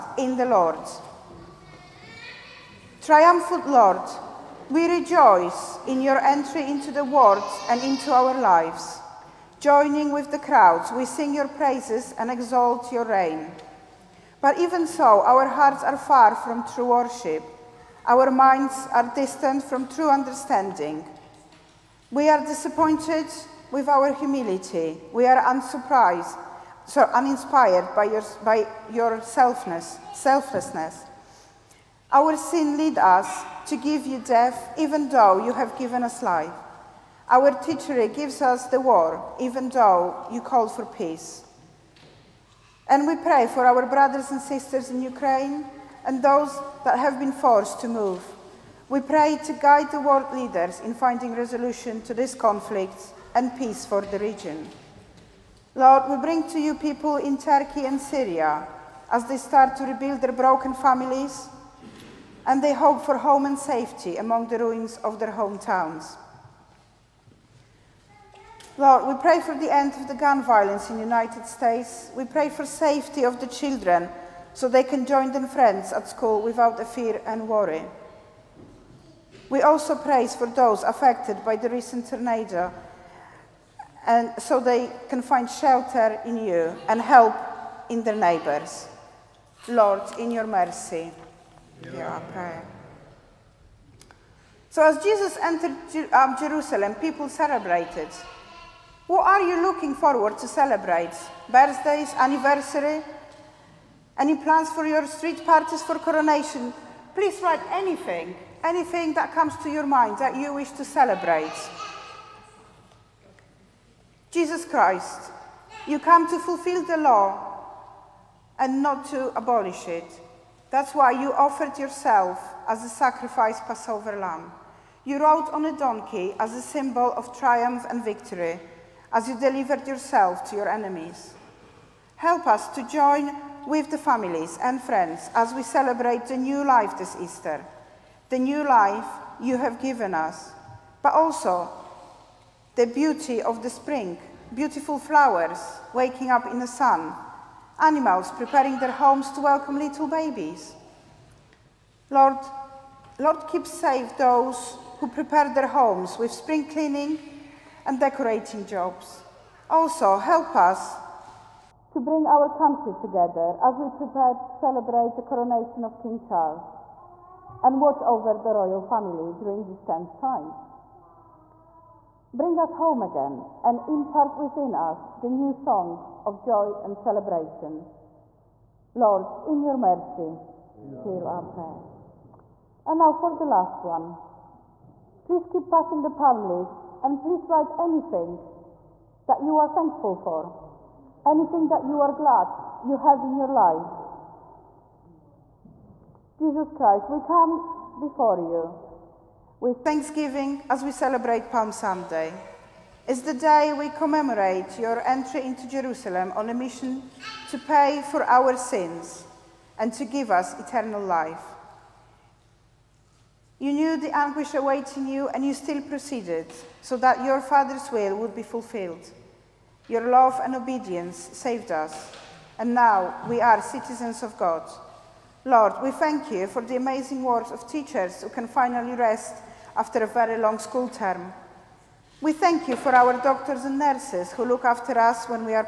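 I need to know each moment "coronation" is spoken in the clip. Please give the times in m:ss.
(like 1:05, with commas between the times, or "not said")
1:45, 2:45.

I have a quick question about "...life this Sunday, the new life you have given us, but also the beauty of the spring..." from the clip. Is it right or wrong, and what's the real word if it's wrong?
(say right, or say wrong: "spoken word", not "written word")
wrong: "Easter", not "Sunday".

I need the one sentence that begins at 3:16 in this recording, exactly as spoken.
Jesus Christ, we come before you with thanksgiving as we celebrate Palm Sunday.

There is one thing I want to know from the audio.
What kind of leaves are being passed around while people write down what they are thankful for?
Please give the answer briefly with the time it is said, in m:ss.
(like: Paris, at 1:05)
palm leaves, at 3:06.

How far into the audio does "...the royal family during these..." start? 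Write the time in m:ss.
2:48.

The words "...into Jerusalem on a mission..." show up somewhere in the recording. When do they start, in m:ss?
3:25.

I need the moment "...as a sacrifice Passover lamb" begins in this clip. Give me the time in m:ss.
2:02.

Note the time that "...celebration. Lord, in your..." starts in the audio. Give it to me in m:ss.
2:56.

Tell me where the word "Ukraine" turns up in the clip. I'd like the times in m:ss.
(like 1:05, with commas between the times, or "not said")
0:45.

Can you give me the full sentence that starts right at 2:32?
Lord, Lord, keep safe those who prepare their homes with spring cleaning and decorating jobs.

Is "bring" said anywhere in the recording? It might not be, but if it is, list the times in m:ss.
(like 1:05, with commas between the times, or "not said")
0:56, 2:41, 2:52.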